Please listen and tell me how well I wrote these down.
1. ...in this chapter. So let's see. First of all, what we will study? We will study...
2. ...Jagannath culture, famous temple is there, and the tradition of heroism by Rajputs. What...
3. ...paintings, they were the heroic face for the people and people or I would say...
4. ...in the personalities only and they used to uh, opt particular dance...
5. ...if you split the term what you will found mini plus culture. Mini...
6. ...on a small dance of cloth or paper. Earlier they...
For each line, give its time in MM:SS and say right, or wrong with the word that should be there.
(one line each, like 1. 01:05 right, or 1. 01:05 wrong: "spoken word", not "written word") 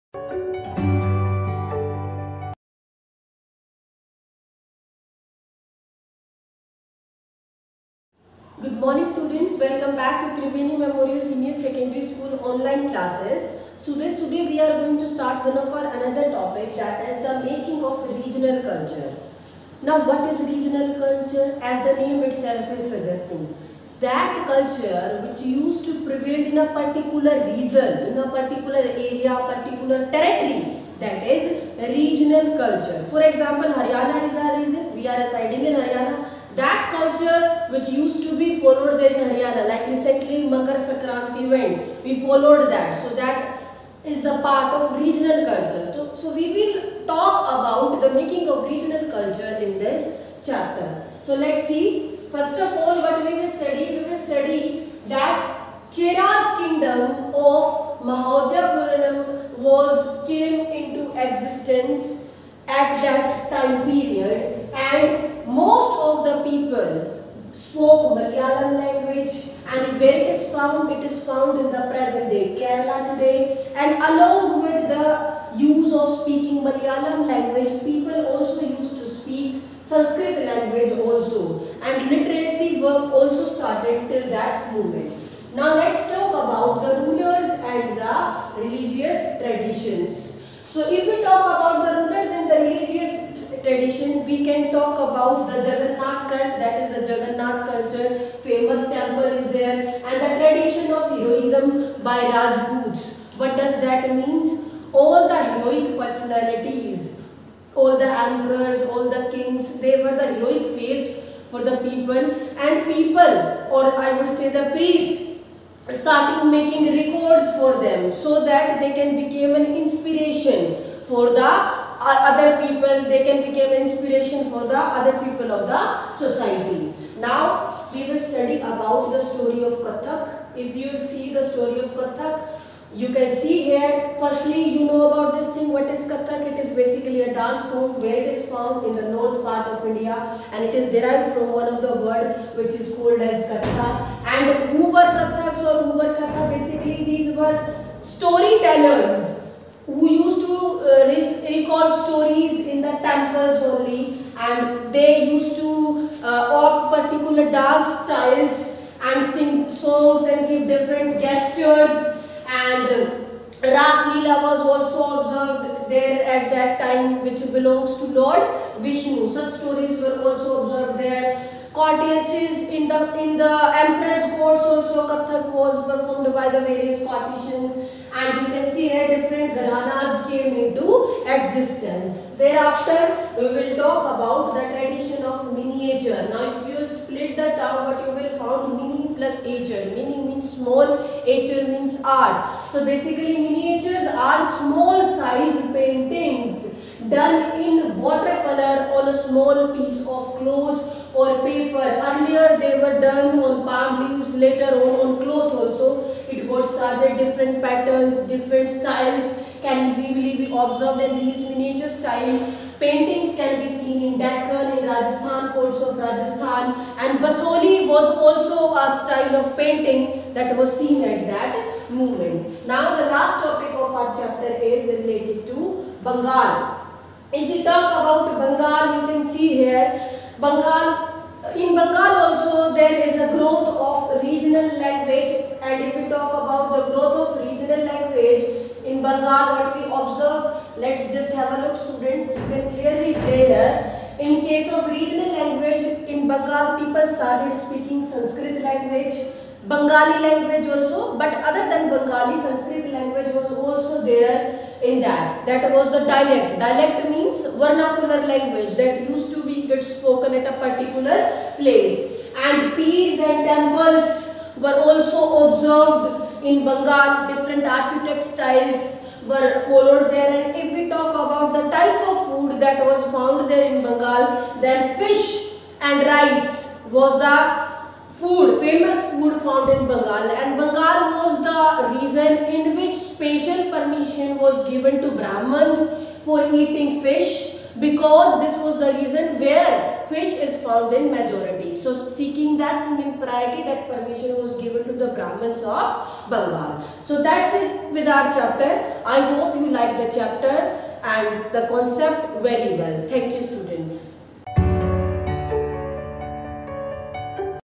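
1. 00:49 right
2. 01:37 right
3. 01:49 wrong: "kings", not "paintings"
4. 02:32 wrong: "temples", not "personalities"
5. 03:06 wrong: "ature", not "culture"
6. 03:18 wrong: "piece", not "dance".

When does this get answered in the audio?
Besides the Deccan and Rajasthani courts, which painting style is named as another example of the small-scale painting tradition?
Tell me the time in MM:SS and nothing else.
03:37.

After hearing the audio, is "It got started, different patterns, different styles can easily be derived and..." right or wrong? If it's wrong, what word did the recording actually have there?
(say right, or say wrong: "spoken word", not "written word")
wrong: "observed", not "derived".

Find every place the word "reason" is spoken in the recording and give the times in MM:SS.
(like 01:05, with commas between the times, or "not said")
04:41, 04:48.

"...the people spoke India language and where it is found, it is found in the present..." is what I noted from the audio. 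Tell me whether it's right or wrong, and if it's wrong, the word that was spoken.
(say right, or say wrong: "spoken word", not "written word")
wrong: "Malayalam", not "India".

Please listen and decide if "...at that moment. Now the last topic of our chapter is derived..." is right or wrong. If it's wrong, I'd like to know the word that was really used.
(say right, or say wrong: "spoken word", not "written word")
wrong: "related", not "derived".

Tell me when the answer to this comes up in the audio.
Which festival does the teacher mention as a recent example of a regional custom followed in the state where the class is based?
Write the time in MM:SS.
00:40.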